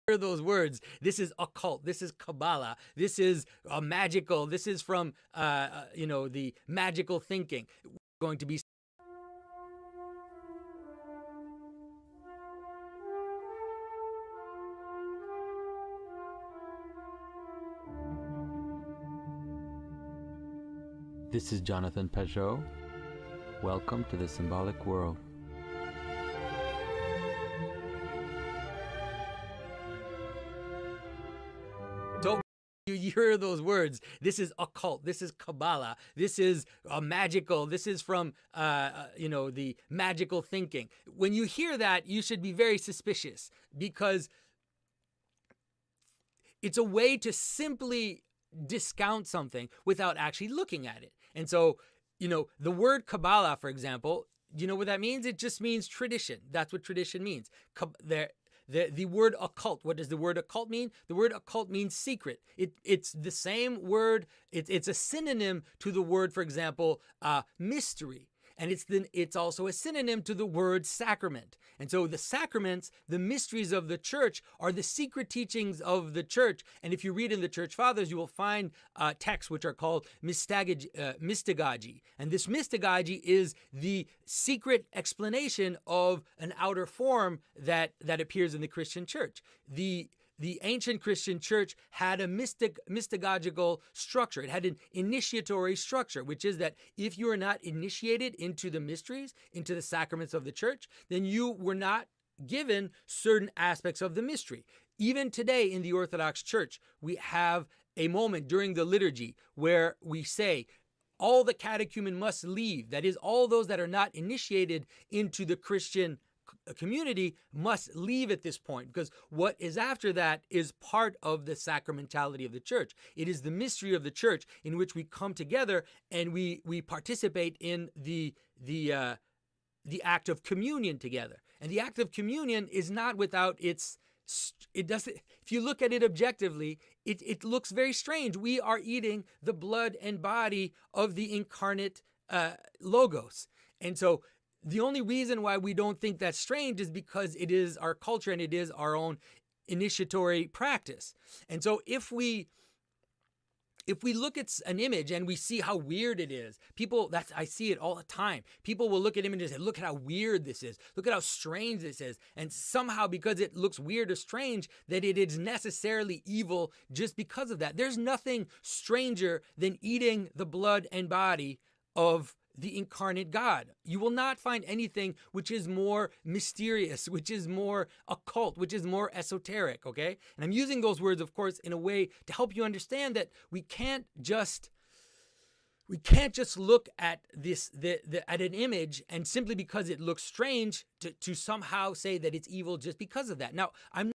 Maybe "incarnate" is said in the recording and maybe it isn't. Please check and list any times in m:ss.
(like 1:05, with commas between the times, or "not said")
2:21, 2:52.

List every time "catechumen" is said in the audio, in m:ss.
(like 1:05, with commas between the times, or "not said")
1:51.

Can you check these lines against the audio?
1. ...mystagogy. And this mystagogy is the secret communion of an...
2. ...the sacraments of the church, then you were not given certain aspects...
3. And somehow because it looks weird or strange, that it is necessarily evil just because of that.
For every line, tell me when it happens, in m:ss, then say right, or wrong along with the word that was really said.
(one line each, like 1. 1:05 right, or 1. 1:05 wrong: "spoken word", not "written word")
1. 1:21 wrong: "explanation", not "communion"
2. 1:39 right
3. 2:42 right.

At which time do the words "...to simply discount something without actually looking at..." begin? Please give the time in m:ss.
0:47.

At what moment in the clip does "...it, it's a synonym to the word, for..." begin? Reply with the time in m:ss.
1:04.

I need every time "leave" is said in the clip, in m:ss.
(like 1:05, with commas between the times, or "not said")
1:52, 1:57.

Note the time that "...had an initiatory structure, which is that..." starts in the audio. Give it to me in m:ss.
1:34.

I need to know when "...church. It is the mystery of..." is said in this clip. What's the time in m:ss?
2:02.